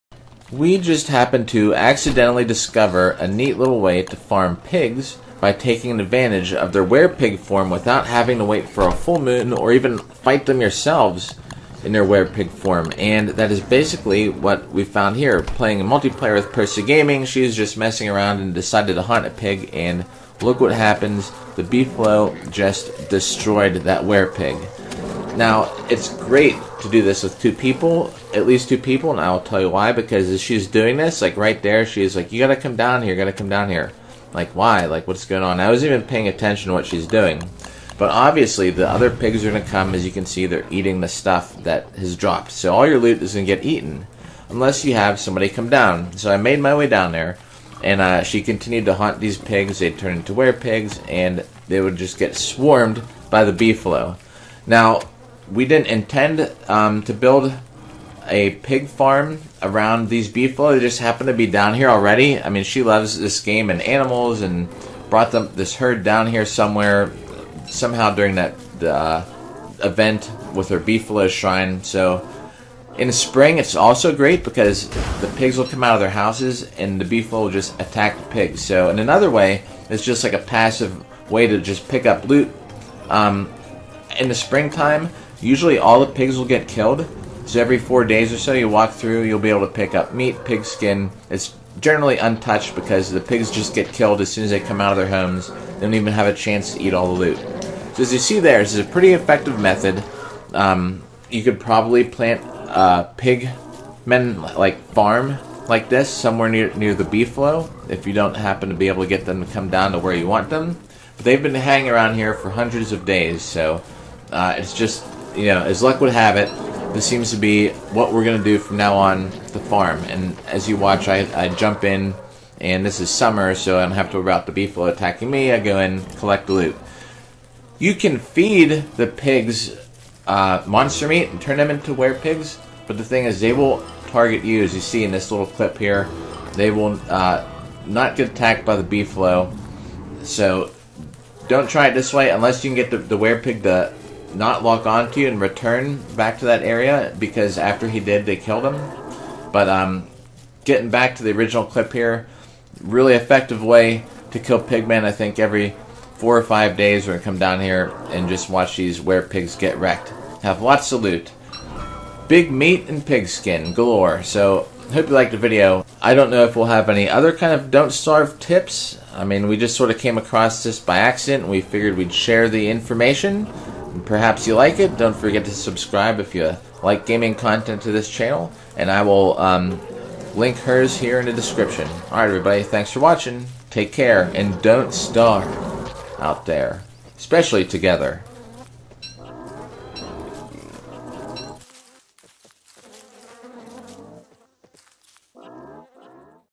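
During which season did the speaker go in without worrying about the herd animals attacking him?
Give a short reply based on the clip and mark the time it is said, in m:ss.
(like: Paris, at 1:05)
Summer, at 2:03.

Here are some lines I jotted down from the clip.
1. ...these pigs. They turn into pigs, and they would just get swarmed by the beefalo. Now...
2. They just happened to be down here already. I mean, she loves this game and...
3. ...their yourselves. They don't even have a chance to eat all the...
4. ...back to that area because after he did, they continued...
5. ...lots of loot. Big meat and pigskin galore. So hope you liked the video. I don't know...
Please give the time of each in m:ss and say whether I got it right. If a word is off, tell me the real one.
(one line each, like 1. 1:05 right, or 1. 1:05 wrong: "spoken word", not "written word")
1. 0:49 right
2. 1:00 right
3. 1:34 wrong: "homes", not "yourselves"
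4. 2:26 wrong: "killed", not "continued"
5. 2:40 right.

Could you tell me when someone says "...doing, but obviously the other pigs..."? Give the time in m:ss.
0:37.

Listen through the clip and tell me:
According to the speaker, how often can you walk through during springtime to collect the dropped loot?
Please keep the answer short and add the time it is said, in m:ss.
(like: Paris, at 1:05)
every 4 days, at 1:27.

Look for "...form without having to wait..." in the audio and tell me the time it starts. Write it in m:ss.
0:07.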